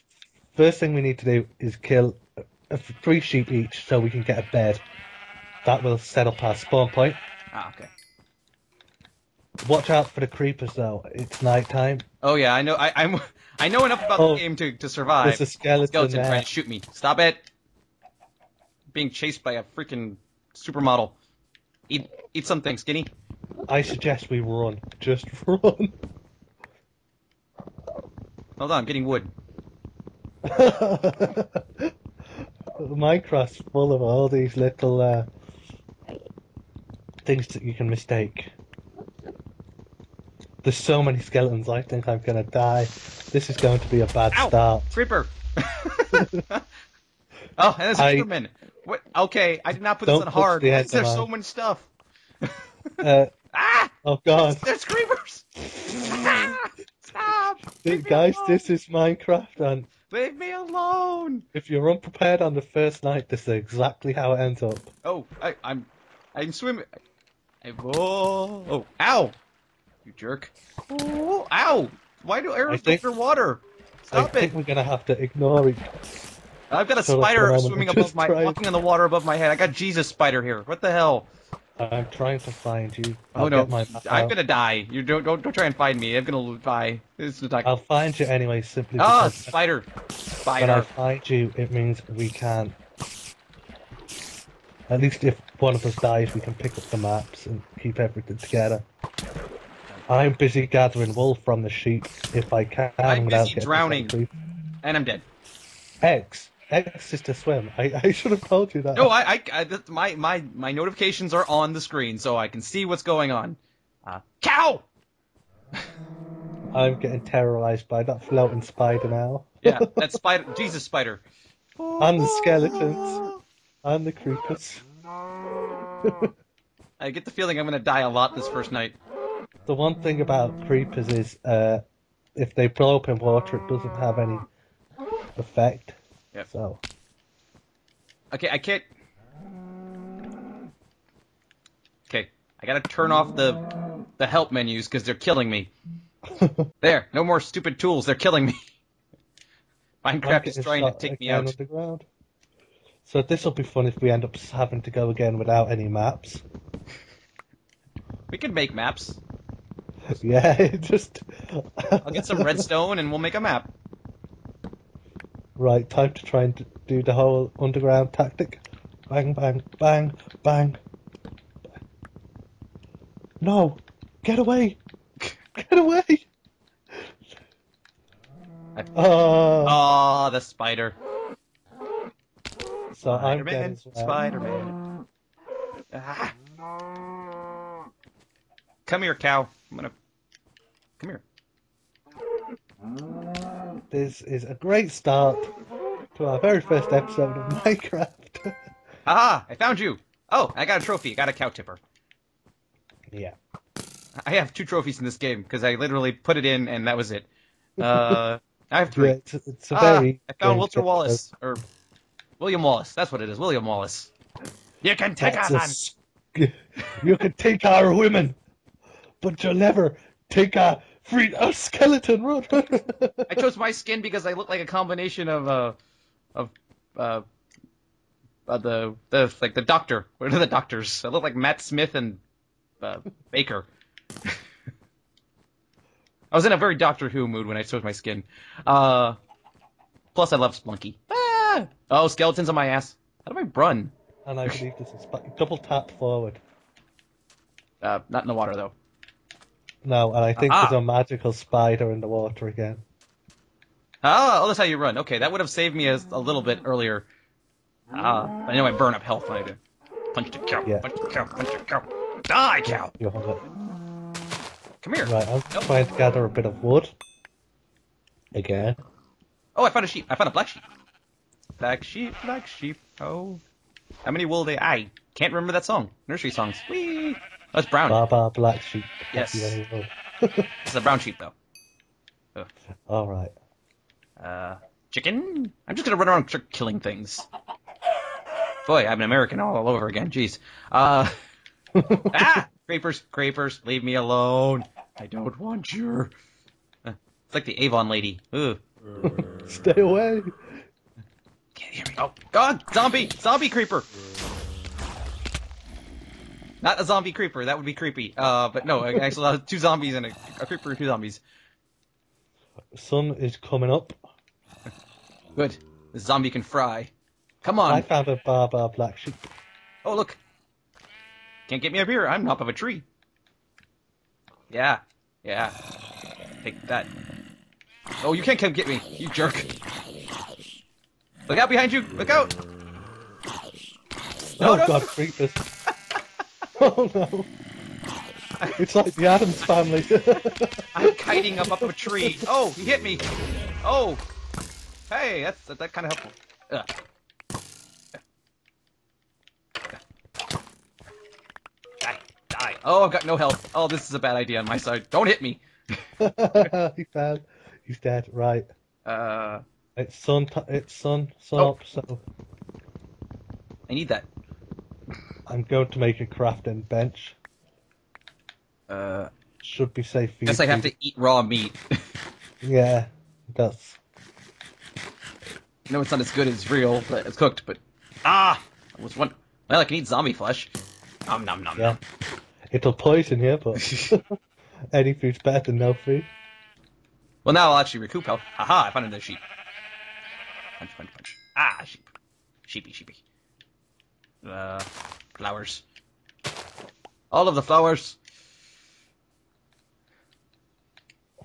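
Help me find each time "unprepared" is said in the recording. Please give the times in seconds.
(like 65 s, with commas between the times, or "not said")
61 s.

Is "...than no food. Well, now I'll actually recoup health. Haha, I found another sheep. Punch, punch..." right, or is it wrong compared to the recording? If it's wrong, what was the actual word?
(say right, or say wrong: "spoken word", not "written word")
right.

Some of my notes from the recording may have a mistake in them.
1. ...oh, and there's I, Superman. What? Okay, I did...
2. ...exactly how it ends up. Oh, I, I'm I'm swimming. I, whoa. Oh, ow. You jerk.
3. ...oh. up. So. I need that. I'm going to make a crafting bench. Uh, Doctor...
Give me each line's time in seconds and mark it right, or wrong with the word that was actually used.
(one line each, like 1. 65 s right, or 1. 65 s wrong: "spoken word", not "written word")
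1. 45 s right
2. 63 s right
3. 361 s wrong: "Should", not "Doctor".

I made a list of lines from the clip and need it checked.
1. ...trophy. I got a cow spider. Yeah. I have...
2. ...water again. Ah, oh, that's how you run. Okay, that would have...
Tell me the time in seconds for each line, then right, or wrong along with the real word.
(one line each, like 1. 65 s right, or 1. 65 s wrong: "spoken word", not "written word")
1. 200 s wrong: "tipper", not "spider"
2. 252 s right.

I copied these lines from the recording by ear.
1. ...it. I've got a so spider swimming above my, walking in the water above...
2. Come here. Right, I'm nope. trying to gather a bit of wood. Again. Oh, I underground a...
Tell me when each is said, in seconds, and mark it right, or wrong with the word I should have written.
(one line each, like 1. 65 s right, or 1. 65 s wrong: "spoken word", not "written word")
1. 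75 s right
2. 264 s wrong: "found", not "underground".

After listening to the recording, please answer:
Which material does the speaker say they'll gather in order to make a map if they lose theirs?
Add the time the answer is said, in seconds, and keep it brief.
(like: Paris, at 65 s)
redstone, at 162 s.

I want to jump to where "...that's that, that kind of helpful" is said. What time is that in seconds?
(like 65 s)
345 s.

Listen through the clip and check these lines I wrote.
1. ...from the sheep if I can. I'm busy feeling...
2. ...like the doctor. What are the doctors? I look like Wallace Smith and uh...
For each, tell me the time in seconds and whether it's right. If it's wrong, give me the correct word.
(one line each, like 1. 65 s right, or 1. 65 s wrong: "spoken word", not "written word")
1. 101 s wrong: "drowning", not "feeling"
2. 229 s wrong: "Matt", not "Wallace".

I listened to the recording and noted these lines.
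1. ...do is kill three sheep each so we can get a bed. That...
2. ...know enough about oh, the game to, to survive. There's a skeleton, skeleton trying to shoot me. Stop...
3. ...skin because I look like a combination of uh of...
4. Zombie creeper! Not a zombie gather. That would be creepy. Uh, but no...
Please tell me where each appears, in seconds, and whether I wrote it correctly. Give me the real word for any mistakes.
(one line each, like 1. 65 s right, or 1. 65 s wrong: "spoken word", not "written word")
1. 1 s right
2. 13 s right
3. 223 s right
4. 303 s wrong: "creeper", not "gather".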